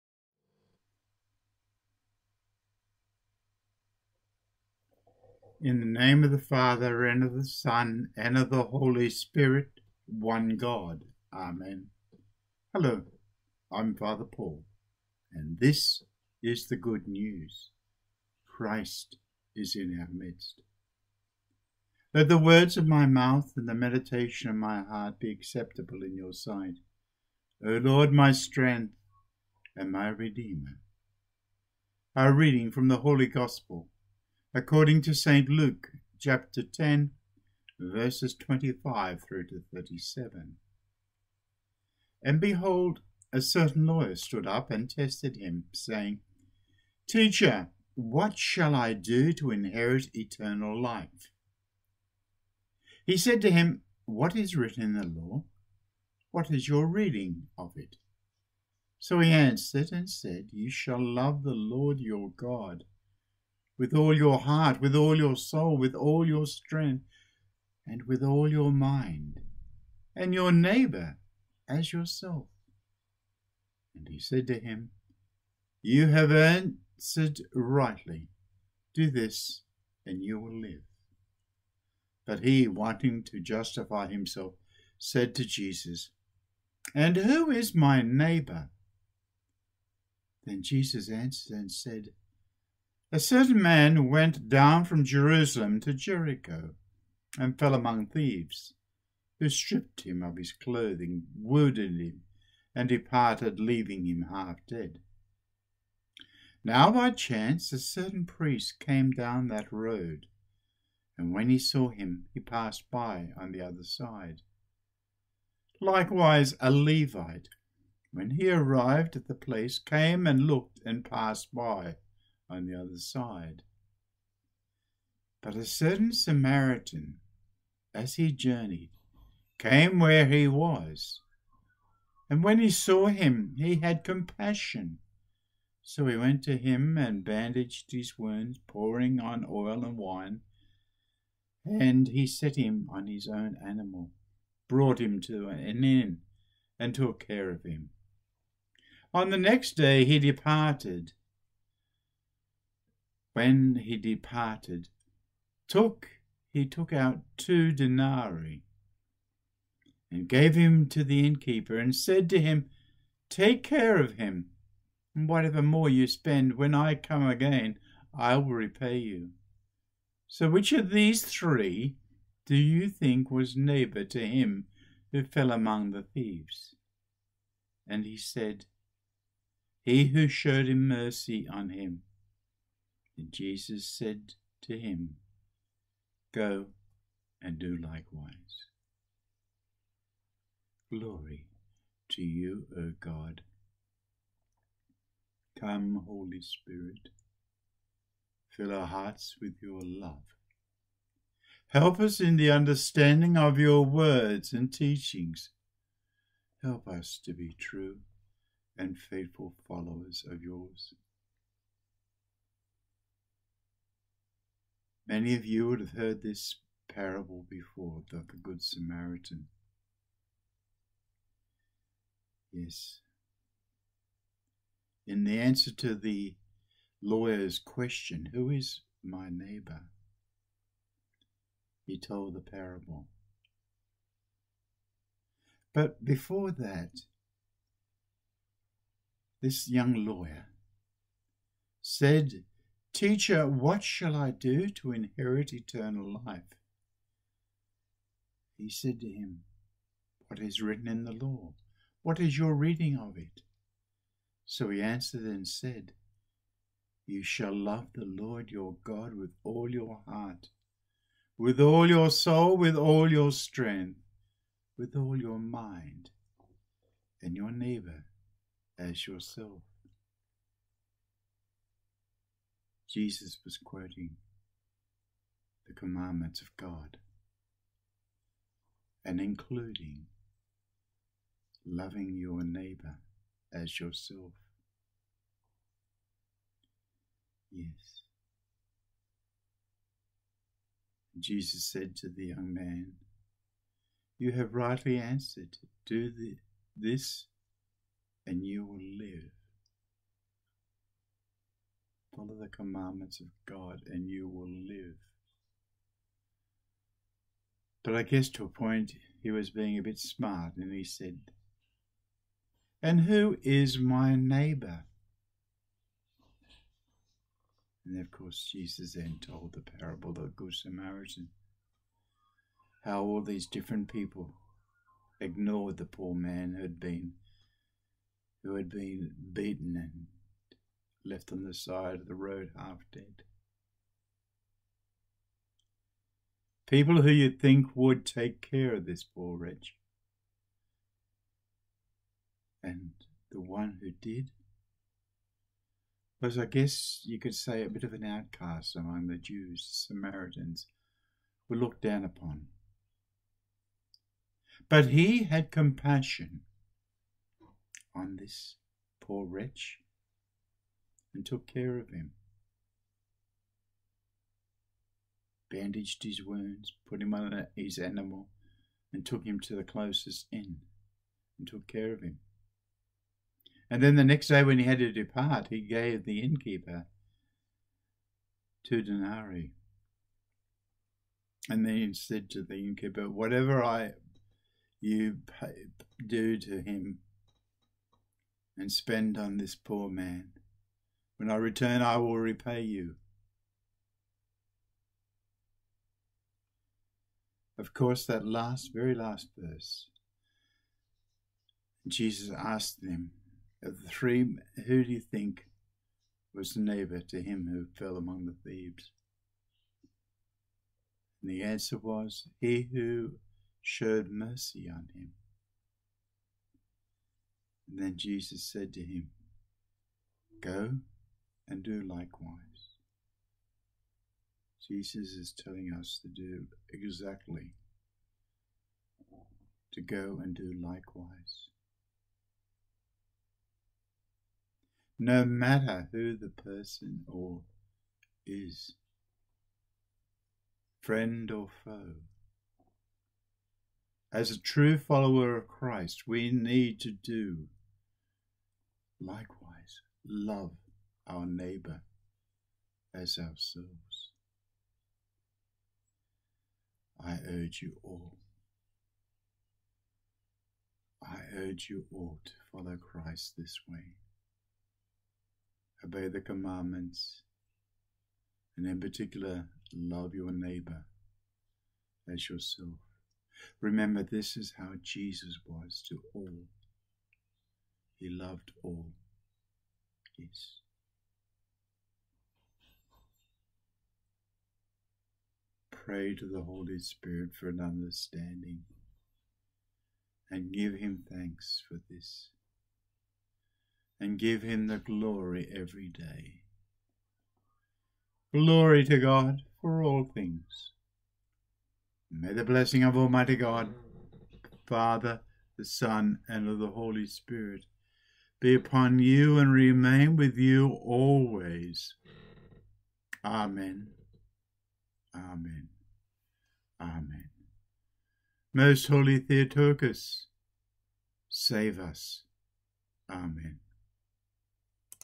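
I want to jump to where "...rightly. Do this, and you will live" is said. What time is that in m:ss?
1:17.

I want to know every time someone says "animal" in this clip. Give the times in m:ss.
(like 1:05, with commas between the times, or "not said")
2:23, 6:07.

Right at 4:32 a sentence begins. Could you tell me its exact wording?
Jesus was quoting the commandments of God and including loving your neighbor as yourself.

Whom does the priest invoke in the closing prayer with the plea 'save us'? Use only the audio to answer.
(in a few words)
Most holy Theotokos.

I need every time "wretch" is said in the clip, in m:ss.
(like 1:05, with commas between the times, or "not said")
5:39, 5:59.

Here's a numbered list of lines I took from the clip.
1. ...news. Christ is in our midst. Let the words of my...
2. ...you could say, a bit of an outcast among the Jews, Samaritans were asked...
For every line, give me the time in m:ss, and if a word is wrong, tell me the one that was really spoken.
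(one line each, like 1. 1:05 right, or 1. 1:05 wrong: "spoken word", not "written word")
1. 0:17 right
2. 5:47 wrong: "looked", not "asked".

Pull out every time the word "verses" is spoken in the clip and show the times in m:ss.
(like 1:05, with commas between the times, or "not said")
0:37, 6:39.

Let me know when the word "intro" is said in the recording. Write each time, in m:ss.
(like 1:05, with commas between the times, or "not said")
not said.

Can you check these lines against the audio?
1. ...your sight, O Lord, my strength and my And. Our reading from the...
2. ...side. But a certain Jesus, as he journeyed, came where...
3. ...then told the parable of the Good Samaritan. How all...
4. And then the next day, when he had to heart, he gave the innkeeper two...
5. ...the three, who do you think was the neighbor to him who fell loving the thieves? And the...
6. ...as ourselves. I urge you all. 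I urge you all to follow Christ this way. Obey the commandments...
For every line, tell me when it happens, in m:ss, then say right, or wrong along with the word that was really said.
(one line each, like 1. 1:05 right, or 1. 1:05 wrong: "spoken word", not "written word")
1. 0:26 wrong: "Redeemer", not "And"
2. 2:02 wrong: "Samaritan", not "Jesus"
3. 5:18 right
4. 6:13 wrong: "depart", not "heart"
5. 6:43 wrong: "among", not "loving"
6. 7:32 right.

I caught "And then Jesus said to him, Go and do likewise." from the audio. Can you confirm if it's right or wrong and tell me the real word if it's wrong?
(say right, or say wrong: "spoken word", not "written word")
right.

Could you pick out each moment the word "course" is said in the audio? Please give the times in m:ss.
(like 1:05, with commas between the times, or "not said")
5:18, 6:37.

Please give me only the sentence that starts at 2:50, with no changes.
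So which of these three do you think was neighbour to him who fell among the thieves?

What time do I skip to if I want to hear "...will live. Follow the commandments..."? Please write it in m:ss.
4:58.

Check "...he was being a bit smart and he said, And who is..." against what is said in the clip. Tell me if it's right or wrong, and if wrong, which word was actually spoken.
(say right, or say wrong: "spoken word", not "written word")
right.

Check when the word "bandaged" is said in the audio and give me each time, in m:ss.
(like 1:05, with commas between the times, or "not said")
2:17, 6:05.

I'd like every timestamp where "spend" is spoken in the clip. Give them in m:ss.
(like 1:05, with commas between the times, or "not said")
2:46, 6:28.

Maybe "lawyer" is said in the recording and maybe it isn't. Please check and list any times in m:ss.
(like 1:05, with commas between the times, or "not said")
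0:43, 3:47, 4:00.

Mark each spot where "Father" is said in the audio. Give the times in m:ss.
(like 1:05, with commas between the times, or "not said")
0:06, 0:13, 8:24.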